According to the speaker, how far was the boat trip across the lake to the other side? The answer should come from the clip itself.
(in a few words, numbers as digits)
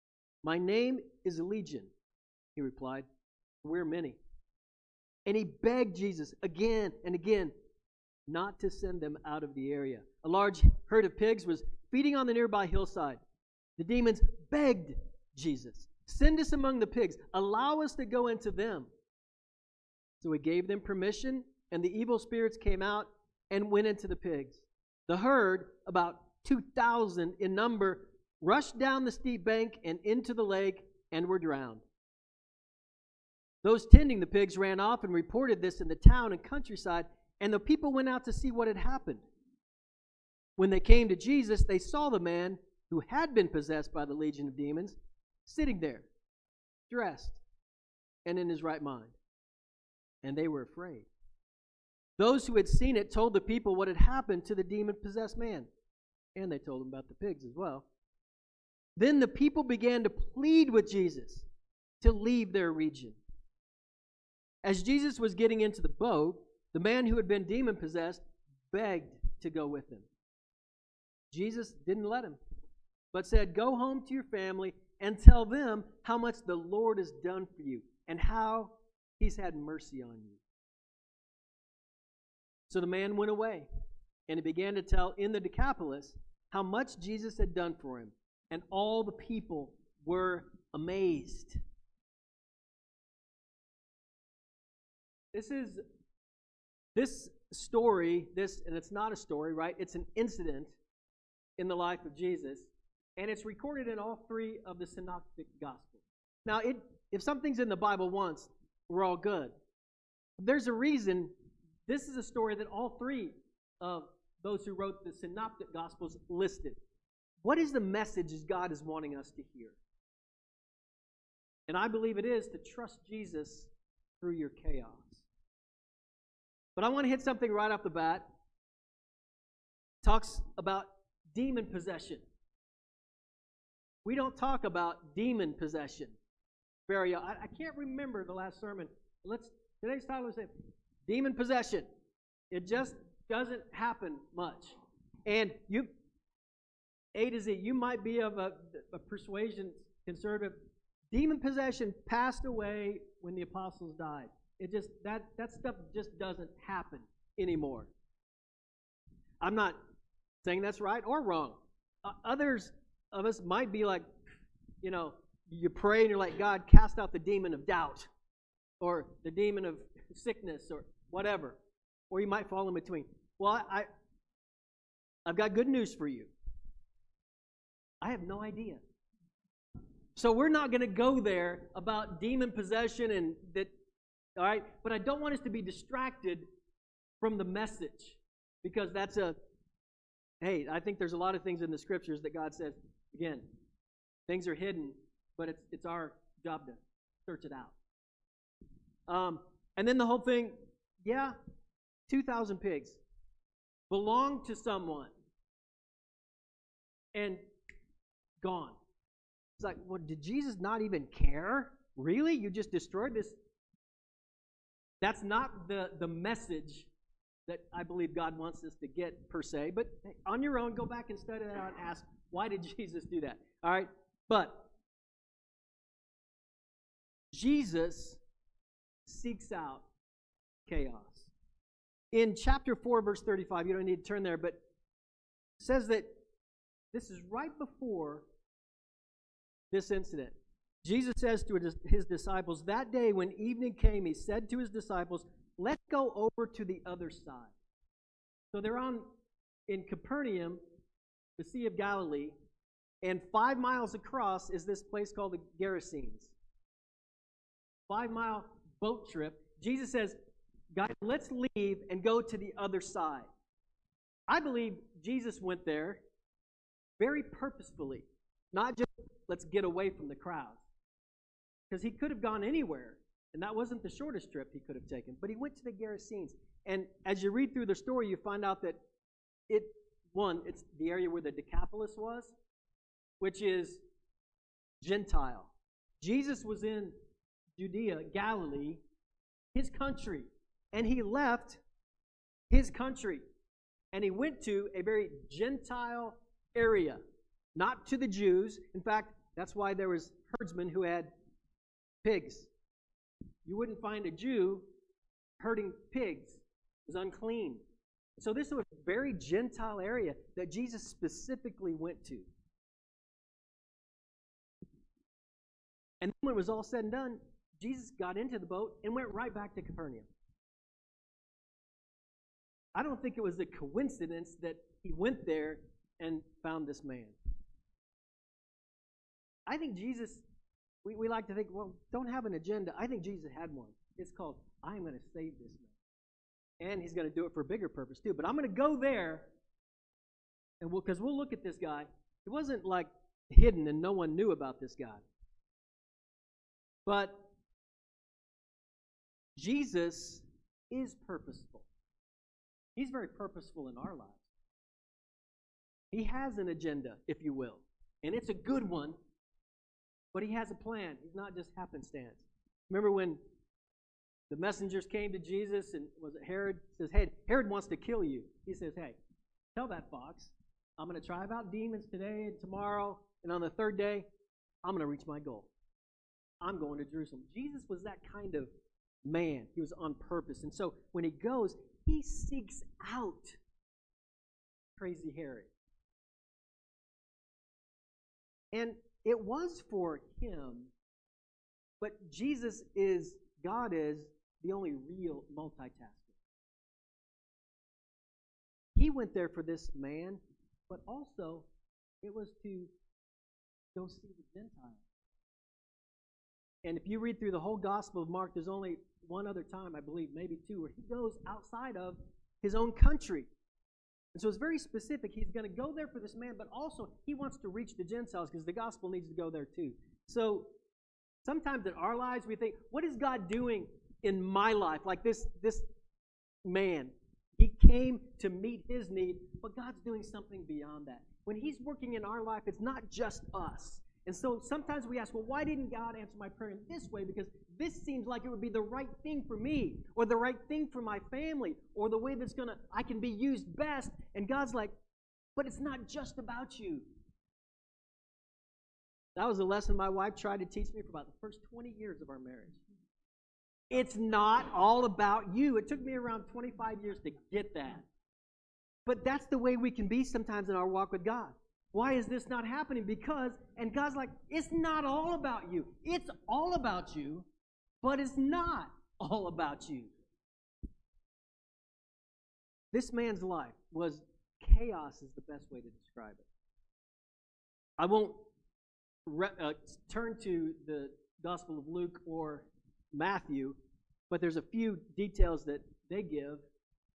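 5 miles.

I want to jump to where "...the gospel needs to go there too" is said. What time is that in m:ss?
6:58.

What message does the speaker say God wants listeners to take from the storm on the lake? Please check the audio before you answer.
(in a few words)
Trust Jesus through your chaos.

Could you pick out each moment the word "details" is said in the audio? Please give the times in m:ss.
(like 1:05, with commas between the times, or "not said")
8:04.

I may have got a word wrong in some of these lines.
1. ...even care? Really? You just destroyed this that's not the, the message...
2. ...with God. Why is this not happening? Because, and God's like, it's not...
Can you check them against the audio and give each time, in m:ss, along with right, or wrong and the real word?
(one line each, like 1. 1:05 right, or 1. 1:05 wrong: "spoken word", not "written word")
1. 3:30 right
2. 7:40 right.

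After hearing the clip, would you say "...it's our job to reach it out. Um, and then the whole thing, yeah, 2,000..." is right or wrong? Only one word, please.
wrong.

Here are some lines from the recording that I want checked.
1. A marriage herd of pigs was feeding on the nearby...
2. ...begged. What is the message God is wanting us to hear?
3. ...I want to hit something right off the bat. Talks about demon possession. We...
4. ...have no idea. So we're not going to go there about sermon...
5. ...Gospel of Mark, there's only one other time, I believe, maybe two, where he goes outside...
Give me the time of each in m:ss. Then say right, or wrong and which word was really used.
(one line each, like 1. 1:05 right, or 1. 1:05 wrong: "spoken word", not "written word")
1. 0:10 wrong: "large", not "marriage"
2. 1:56 wrong: "listed", not "begged"
3. 2:06 right
4. 2:58 wrong: "demon", not "sermon"
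5. 6:47 right.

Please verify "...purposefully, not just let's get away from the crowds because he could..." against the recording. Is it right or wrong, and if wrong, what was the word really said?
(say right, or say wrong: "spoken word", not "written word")
right.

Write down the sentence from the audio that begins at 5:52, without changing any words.
He's very purposeful in our lives.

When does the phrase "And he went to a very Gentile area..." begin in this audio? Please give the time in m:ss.
4:53.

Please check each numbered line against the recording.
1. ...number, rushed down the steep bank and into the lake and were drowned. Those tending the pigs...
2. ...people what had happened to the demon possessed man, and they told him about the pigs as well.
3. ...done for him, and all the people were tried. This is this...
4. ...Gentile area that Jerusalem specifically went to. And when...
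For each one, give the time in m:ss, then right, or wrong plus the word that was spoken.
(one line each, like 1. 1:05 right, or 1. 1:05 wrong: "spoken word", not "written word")
1. 0:27 right
2. 0:53 right
3. 1:27 wrong: "amazed", not "tried"
4. 5:09 wrong: "Jesus", not "Jerusalem".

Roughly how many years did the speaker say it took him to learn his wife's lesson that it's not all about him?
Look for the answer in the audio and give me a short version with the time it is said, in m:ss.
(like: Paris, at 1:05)
25, at 7:35.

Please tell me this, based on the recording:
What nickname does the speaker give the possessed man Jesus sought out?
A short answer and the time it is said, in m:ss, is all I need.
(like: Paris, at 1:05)
Crazy Harry, at 6:24.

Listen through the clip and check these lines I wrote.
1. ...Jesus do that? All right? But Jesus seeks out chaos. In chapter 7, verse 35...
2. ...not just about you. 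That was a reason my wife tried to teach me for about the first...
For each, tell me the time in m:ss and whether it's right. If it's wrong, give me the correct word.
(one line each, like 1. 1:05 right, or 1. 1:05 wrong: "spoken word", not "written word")
1. 3:42 wrong: "4", not "7"
2. 7:25 wrong: "lesson", not "reason".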